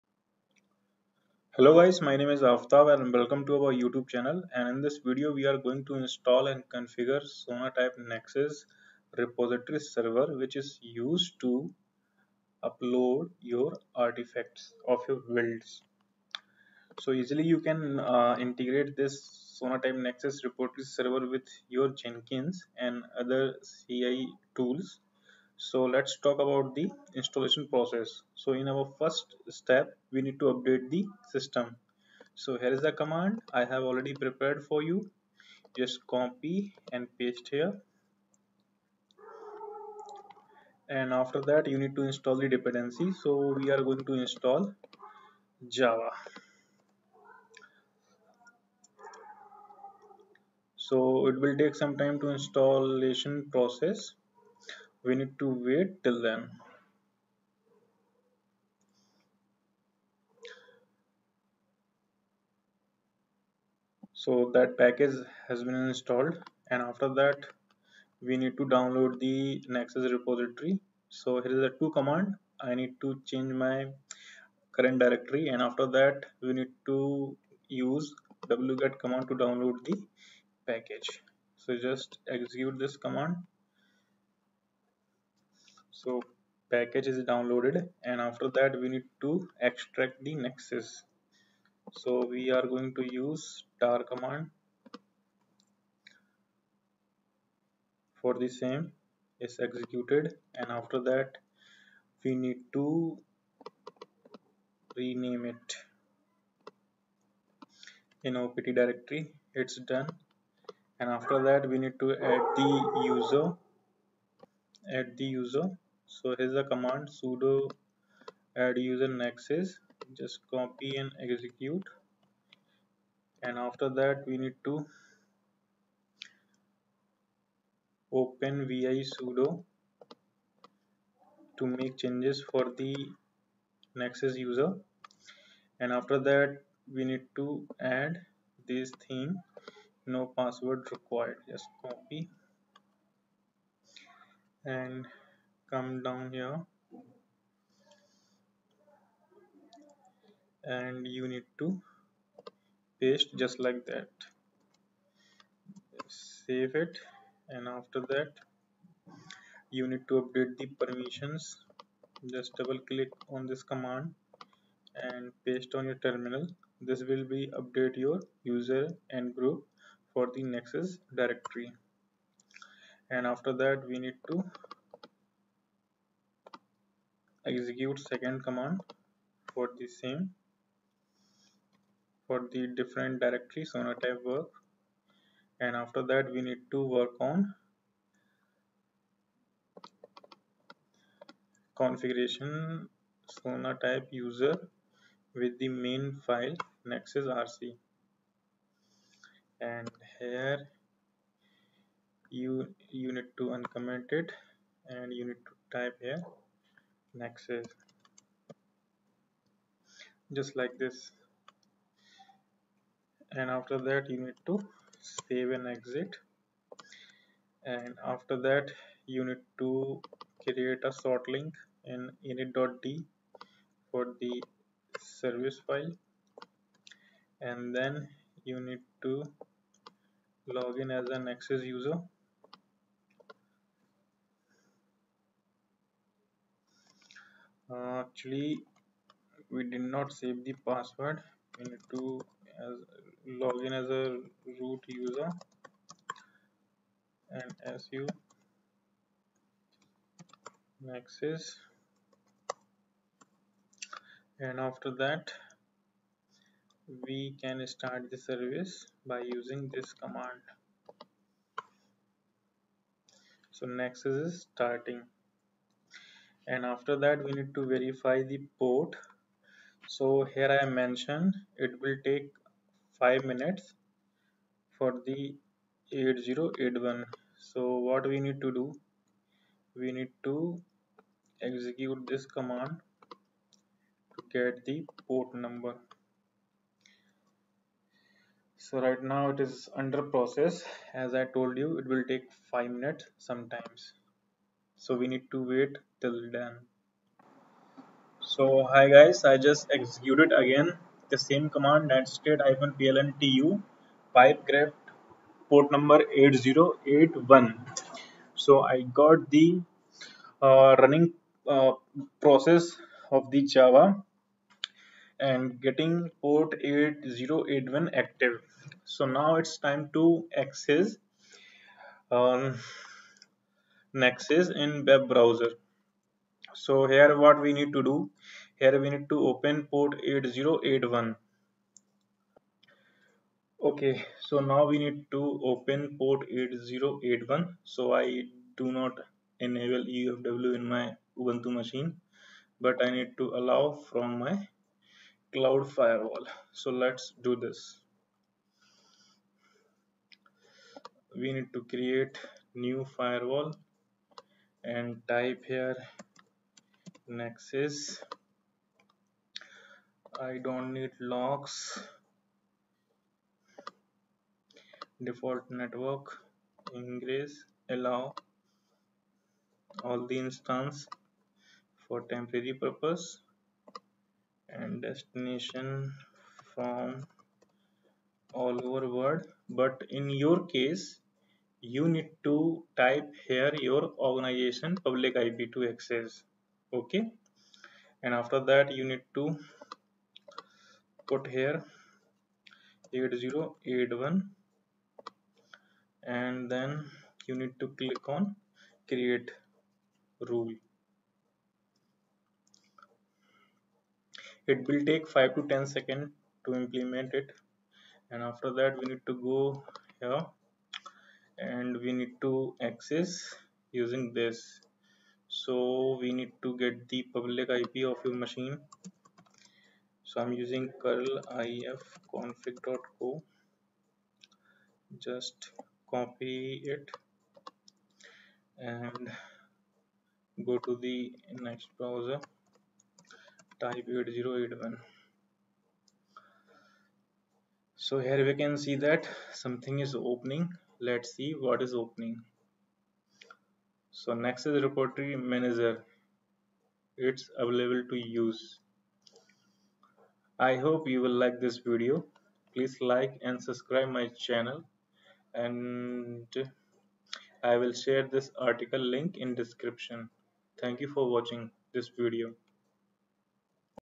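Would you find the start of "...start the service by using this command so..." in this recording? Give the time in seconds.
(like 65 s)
257 s.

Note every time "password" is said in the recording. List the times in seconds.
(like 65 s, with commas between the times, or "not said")
140 s, 240 s.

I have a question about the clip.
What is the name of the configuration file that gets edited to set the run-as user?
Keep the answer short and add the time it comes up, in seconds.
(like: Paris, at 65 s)
nexus rc, at 196 s.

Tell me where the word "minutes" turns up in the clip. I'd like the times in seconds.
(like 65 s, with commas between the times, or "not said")
273 s, 292 s.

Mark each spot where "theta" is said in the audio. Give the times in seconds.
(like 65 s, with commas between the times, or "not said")
not said.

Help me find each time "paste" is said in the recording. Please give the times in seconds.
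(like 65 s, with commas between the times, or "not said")
37 s, 152 s, 165 s.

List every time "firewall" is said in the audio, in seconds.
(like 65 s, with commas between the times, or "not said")
345 s, 352 s.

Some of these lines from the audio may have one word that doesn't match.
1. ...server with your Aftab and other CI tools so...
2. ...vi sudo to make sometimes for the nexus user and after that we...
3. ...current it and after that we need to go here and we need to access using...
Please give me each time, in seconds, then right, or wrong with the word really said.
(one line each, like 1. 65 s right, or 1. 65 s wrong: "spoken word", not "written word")
1. 20 s wrong: "Jenkins", not "Aftab"
2. 128 s wrong: "changes", not "sometimes"
3. 406 s wrong: "implement", not "current".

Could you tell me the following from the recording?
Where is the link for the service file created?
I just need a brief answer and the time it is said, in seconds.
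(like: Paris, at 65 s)
init.d, at 222 s.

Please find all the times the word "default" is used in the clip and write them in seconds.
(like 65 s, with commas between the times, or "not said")
365 s.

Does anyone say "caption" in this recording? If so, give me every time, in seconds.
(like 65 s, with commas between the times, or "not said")
not said.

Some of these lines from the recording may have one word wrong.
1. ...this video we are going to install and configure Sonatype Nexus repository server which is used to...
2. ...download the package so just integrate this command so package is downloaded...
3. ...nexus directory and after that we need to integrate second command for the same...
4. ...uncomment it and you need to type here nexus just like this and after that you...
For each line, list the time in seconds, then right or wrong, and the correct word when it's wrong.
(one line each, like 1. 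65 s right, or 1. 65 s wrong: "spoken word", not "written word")
1. 4 s right
2. 79 s wrong: "execute", not "integrate"
3. 170 s wrong: "execute", not "integrate"
4. 203 s right.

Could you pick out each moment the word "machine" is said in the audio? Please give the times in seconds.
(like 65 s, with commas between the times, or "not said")
341 s, 418 s.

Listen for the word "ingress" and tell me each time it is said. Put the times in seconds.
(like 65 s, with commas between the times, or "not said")
366 s.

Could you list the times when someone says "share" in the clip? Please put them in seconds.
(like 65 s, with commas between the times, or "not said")
457 s.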